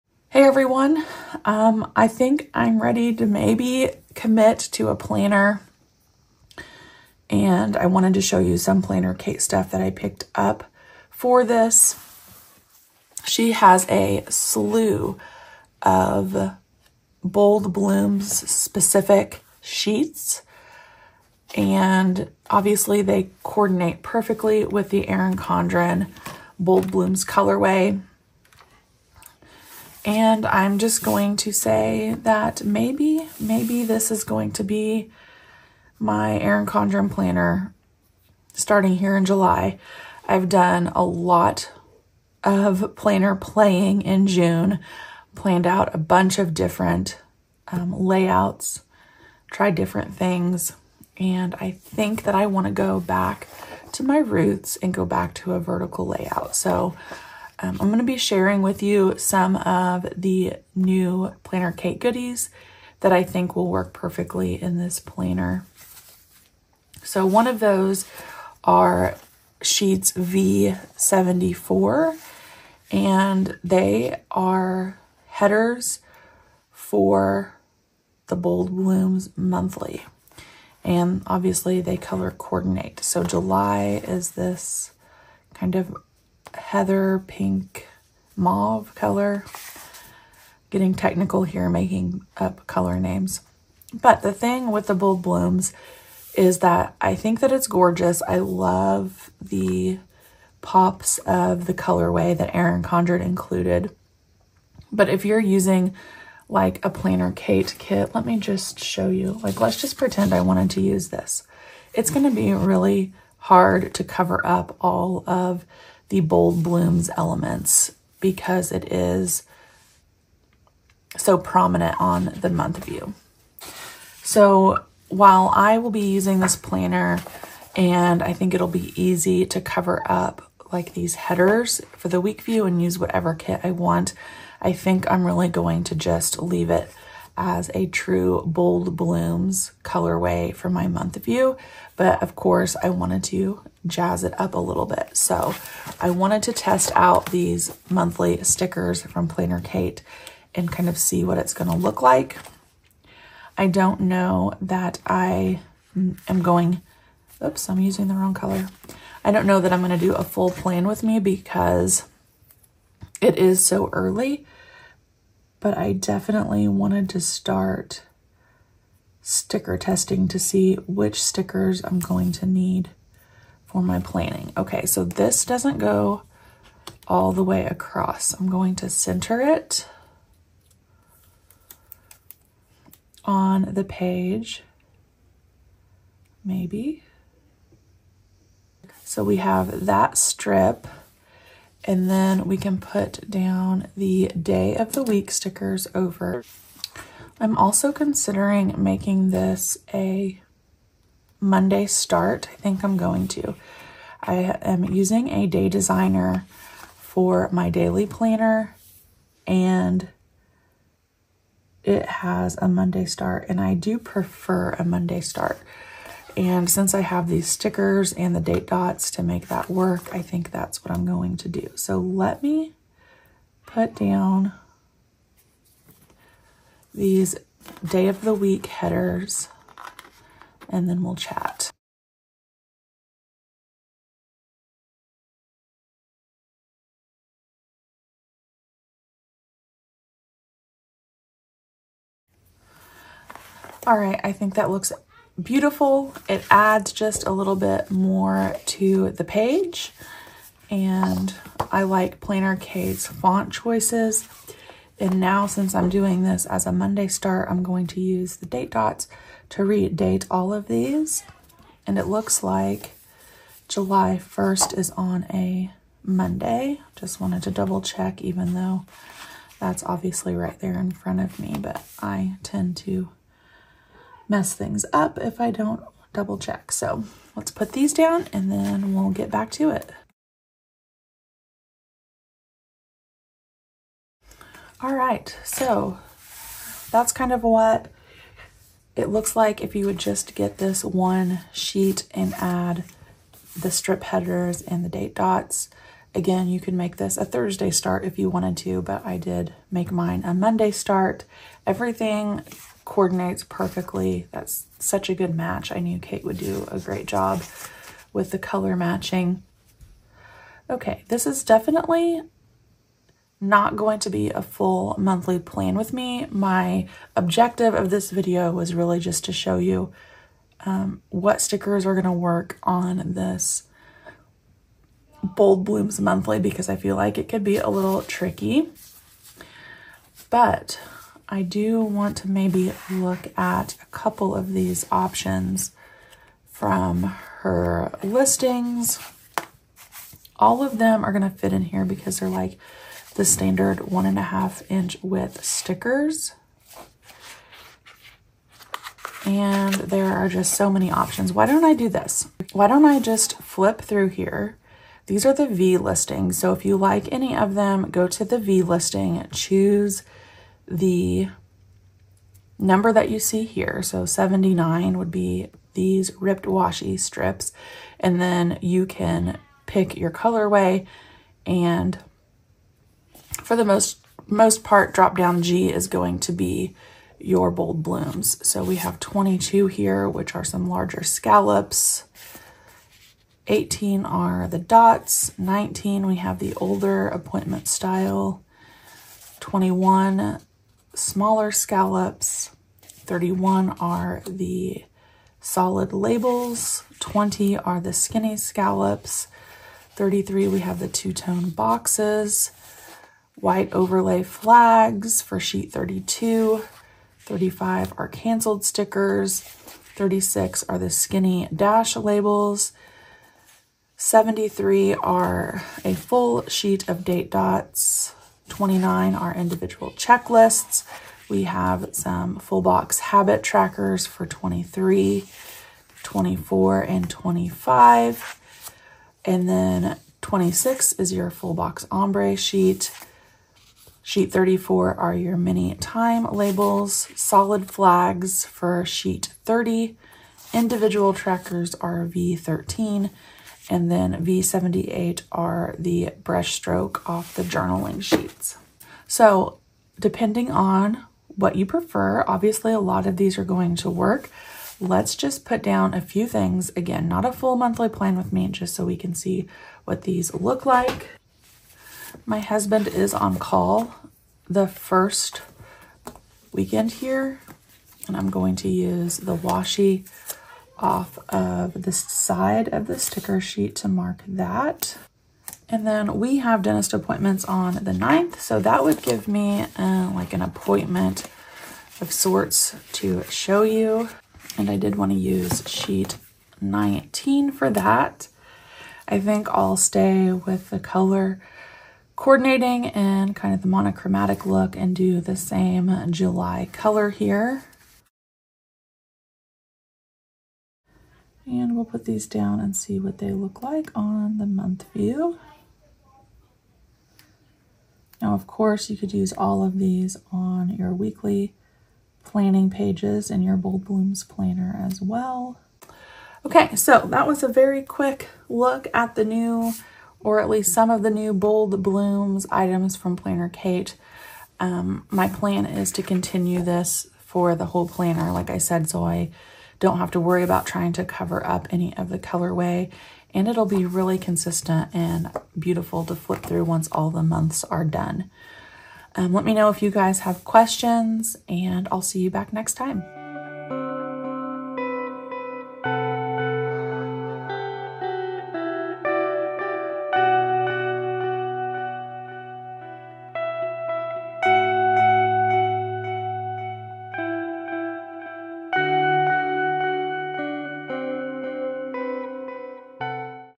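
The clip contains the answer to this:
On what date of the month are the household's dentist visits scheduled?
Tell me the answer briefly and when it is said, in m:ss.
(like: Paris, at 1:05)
9th, at 7:57.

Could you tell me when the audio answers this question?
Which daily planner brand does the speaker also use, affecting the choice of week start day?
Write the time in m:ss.
3:25.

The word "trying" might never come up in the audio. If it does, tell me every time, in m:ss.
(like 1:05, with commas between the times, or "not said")
8:50.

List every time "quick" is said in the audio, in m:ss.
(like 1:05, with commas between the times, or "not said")
8:37.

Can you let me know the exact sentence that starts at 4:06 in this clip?
It adds just a little bit more to the page.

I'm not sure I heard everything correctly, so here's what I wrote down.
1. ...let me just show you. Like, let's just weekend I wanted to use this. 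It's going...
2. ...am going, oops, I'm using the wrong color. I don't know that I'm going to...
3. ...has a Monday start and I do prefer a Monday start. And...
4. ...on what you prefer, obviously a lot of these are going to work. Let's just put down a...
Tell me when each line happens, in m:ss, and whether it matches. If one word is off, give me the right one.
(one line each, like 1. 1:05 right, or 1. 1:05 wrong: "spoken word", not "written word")
1. 1:48 wrong: "pretend", not "weekend"
2. 2:35 right
3. 3:32 right
4. 7:30 right.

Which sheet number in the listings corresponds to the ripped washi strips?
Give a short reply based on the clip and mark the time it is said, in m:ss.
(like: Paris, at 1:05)
79, at 6:04.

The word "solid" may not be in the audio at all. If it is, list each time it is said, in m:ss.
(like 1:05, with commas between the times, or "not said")
6:35, 7:17.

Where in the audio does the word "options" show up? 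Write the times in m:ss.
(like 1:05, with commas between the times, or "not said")
5:34, 5:50.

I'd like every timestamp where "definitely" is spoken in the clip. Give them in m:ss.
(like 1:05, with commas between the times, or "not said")
2:45, 5:11.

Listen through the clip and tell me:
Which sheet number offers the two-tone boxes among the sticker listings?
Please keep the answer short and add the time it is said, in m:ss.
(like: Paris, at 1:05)
33, at 6:39.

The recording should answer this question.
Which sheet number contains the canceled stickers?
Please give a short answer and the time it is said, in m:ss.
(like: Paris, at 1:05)
35, at 6:47.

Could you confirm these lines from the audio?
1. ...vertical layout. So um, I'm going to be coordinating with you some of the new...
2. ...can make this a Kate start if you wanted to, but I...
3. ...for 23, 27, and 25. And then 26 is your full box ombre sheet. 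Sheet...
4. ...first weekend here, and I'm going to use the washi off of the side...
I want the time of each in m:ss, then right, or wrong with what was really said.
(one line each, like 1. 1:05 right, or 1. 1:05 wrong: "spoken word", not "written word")
1. 0:55 wrong: "sharing", not "coordinating"
2. 4:56 wrong: "Thursday", not "Kate"
3. 7:04 wrong: "24", not "27"
4. 7:44 right.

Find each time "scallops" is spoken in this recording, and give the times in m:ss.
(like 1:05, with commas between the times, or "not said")
6:21, 6:31, 6:38.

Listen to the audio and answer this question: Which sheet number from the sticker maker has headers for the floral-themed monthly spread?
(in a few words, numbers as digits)
V74.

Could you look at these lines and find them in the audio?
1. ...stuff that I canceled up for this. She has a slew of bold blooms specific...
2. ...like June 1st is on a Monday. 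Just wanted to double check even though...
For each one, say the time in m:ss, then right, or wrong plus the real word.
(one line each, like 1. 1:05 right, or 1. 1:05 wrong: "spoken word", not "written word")
1. 0:09 wrong: "picked", not "canceled"
2. 4:22 wrong: "July", not "June".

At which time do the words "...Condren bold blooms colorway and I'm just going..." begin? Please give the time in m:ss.
0:25.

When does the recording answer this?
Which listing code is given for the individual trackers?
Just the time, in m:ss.
7:22.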